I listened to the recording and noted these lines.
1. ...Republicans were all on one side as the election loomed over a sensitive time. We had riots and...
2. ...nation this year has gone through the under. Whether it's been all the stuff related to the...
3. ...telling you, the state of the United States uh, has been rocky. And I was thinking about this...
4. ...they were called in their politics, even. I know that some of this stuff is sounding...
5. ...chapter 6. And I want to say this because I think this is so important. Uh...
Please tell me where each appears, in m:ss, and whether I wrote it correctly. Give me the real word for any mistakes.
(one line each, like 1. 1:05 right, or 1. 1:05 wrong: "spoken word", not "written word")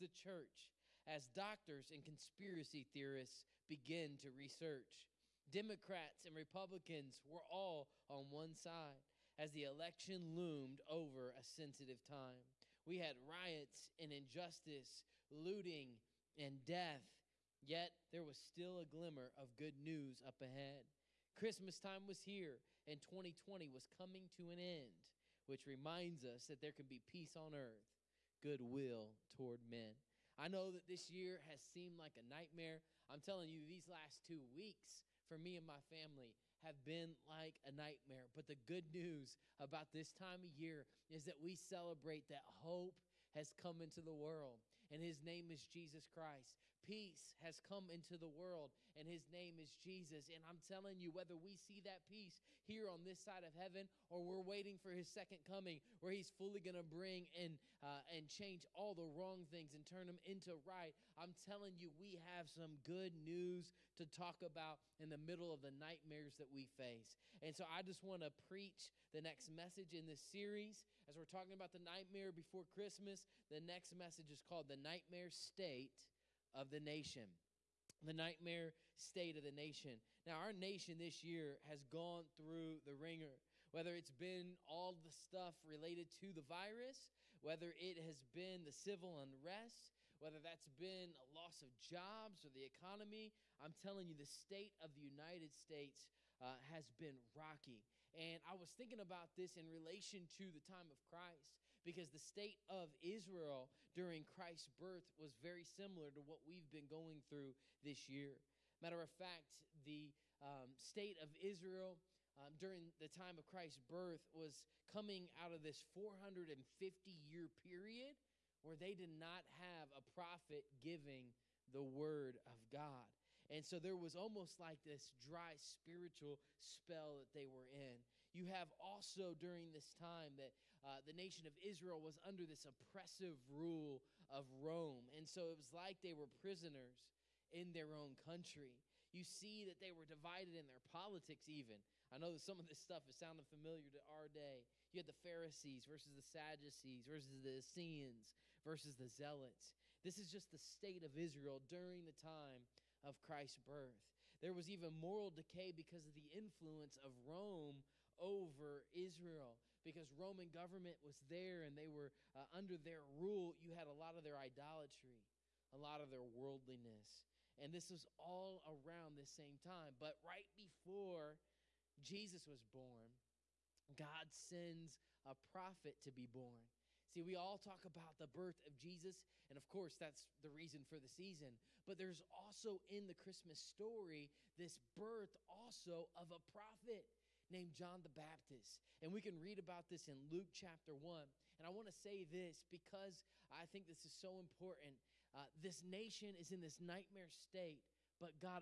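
1. 0:06 right
2. 1:20 wrong: "wringer", not "under"
3. 1:33 right
4. 2:19 wrong: "divided", not "called"
5. 3:10 wrong: "1", not "6".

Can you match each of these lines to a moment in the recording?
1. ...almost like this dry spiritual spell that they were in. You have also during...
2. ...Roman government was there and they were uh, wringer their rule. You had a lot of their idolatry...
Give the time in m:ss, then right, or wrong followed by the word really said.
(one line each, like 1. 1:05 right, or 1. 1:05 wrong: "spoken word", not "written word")
1. 2:04 right
2. 2:40 wrong: "under", not "wringer".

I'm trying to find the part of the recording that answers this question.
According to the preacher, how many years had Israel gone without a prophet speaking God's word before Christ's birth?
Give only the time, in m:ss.
1:55.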